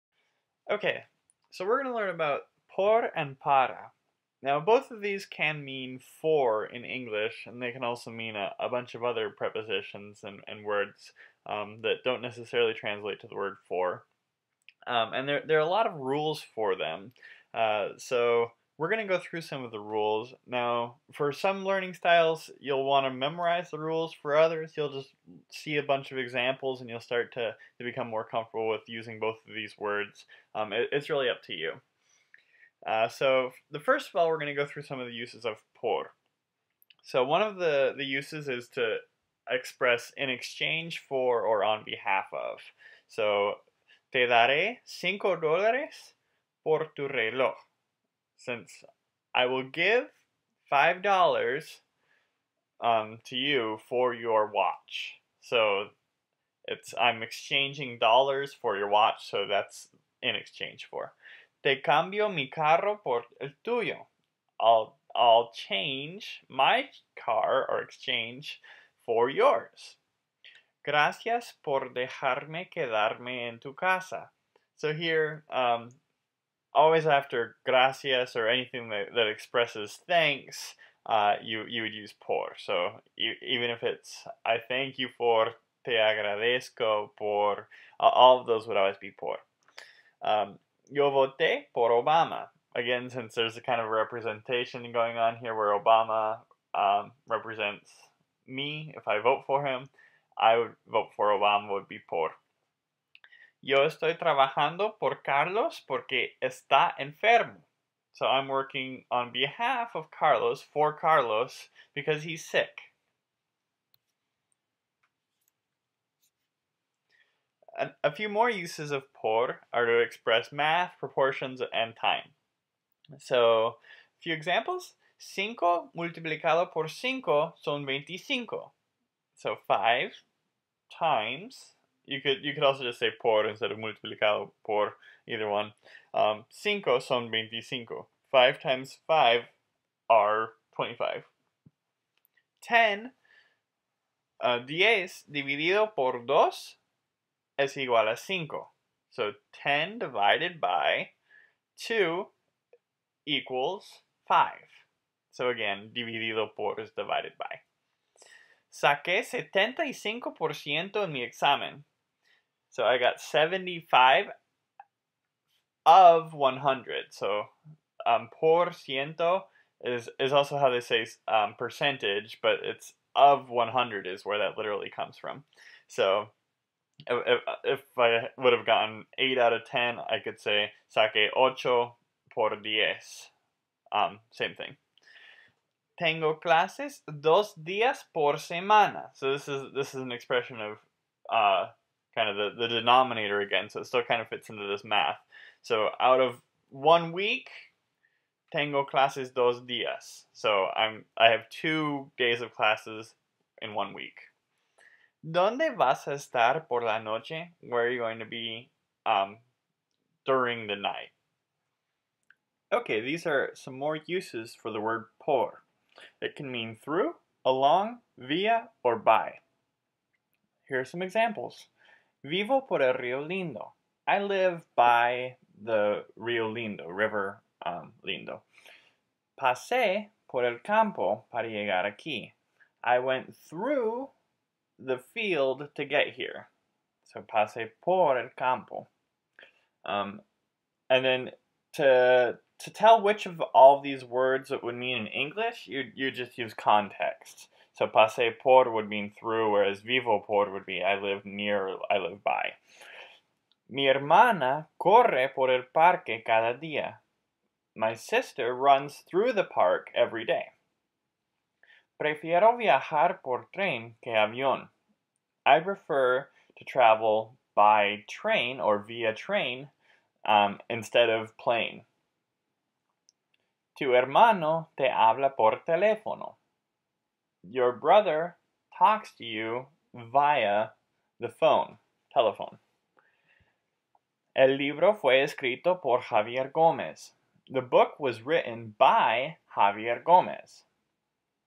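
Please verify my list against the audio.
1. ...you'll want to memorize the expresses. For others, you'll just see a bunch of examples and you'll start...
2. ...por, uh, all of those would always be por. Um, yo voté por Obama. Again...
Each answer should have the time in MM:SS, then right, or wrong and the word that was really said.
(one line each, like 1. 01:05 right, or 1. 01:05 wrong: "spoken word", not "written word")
1. 00:22 wrong: "rules", not "expresses"
2. 01:27 right.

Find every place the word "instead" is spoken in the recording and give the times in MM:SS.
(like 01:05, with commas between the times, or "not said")
02:13, 04:30.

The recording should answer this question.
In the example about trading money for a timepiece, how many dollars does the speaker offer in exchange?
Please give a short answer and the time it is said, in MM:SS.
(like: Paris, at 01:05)
5, at 00:44.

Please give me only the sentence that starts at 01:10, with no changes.
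Gracias por dejarme quedarme en tu casa.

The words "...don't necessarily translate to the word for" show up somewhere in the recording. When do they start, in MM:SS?
00:12.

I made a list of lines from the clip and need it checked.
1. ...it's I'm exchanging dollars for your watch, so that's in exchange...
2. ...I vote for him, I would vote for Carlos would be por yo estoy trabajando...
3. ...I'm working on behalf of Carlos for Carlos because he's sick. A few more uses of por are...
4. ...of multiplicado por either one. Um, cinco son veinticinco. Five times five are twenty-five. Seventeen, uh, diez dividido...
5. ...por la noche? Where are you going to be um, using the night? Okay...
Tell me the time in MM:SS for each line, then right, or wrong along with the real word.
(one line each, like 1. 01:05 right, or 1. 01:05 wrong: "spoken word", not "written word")
1. 00:56 right
2. 01:39 wrong: "Obama", not "Carlos"
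3. 01:48 right
4. 02:13 wrong: "Ten", not "Seventeen"
5. 03:26 wrong: "during", not "using".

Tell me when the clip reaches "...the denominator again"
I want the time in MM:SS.
03:12.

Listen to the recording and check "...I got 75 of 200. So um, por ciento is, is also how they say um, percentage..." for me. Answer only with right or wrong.
wrong.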